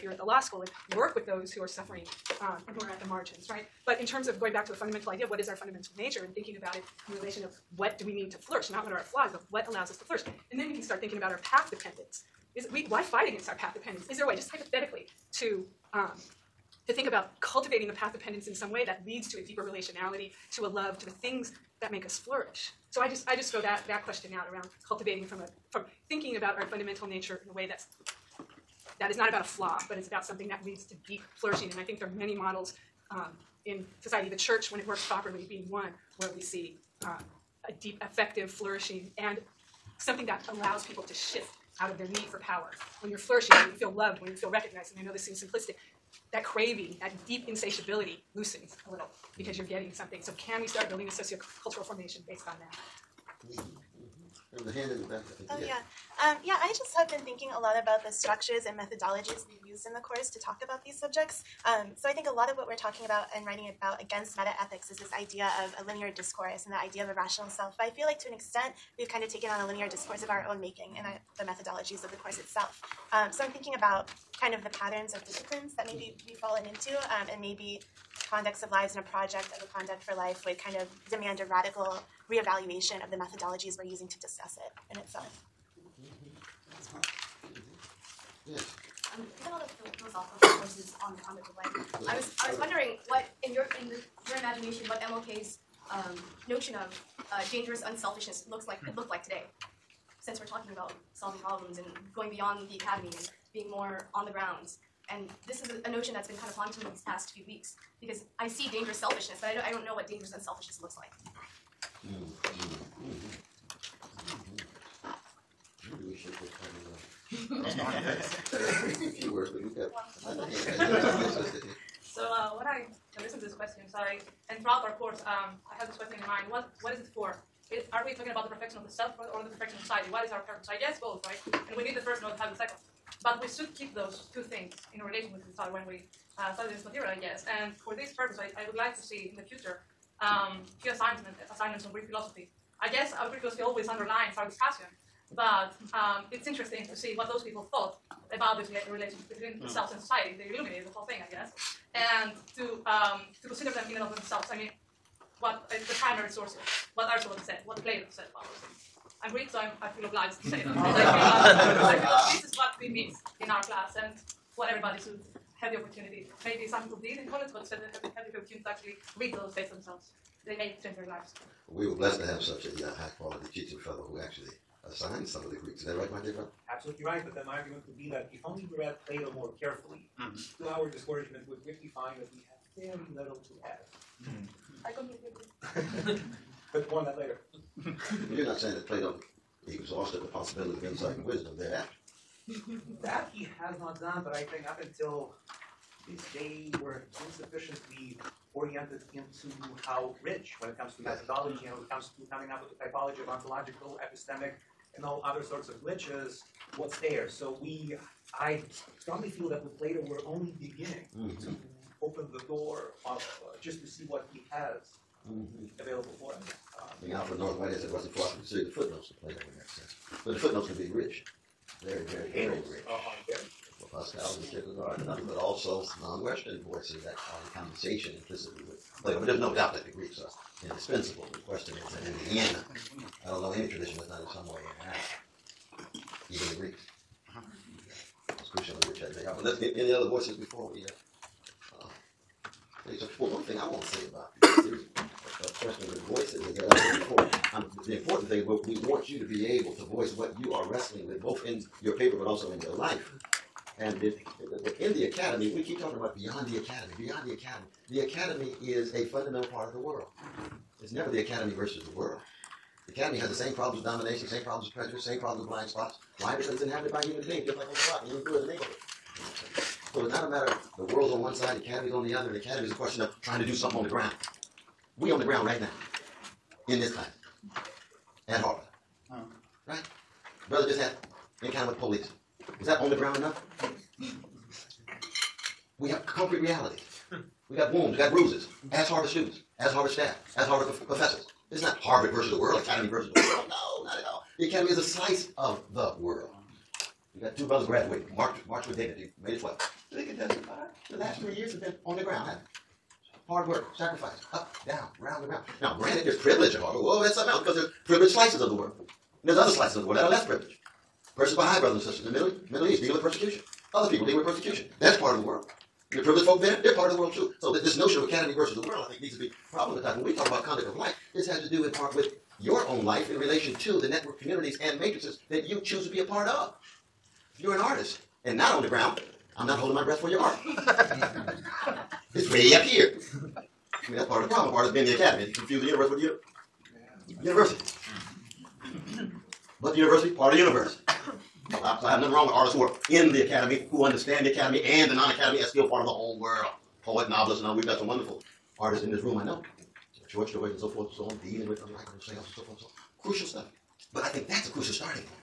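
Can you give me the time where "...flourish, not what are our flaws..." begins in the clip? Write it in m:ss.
0:08.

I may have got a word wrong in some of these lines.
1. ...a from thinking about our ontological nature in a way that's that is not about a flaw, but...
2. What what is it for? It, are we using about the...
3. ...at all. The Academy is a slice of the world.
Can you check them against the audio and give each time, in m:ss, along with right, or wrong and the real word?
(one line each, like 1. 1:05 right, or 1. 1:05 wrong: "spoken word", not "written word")
1. 0:25 wrong: "fundamental", not "ontological"
2. 2:06 wrong: "talking", not "using"
3. 4:53 right.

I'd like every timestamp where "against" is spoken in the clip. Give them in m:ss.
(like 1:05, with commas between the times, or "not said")
0:13, 1:04.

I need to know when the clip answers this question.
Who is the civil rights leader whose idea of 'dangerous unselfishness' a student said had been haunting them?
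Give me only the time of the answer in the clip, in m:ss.
1:35.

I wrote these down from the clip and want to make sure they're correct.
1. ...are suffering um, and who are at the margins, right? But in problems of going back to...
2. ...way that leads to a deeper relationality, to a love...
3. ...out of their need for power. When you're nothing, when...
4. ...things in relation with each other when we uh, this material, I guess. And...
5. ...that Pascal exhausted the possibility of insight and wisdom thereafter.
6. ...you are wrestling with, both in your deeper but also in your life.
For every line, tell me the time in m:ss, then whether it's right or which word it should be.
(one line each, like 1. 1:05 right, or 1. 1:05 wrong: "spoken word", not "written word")
1. 0:01 wrong: "terms", not "problems"
2. 0:18 right
3. 0:41 wrong: "flourishing", not "nothing"
4. 2:14 right
5. 3:08 wrong: "Plato", not "Pascal"
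6. 4:10 wrong: "paper", not "deeper".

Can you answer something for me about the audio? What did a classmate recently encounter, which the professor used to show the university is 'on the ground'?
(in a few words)
the police.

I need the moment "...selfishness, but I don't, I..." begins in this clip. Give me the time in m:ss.
1:48.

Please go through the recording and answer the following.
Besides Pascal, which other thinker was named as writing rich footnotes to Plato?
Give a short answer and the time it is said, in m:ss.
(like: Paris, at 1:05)
Kierkegaard, at 3:44.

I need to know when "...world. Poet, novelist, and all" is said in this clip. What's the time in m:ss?
5:46.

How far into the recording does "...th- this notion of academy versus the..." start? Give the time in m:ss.
5:17.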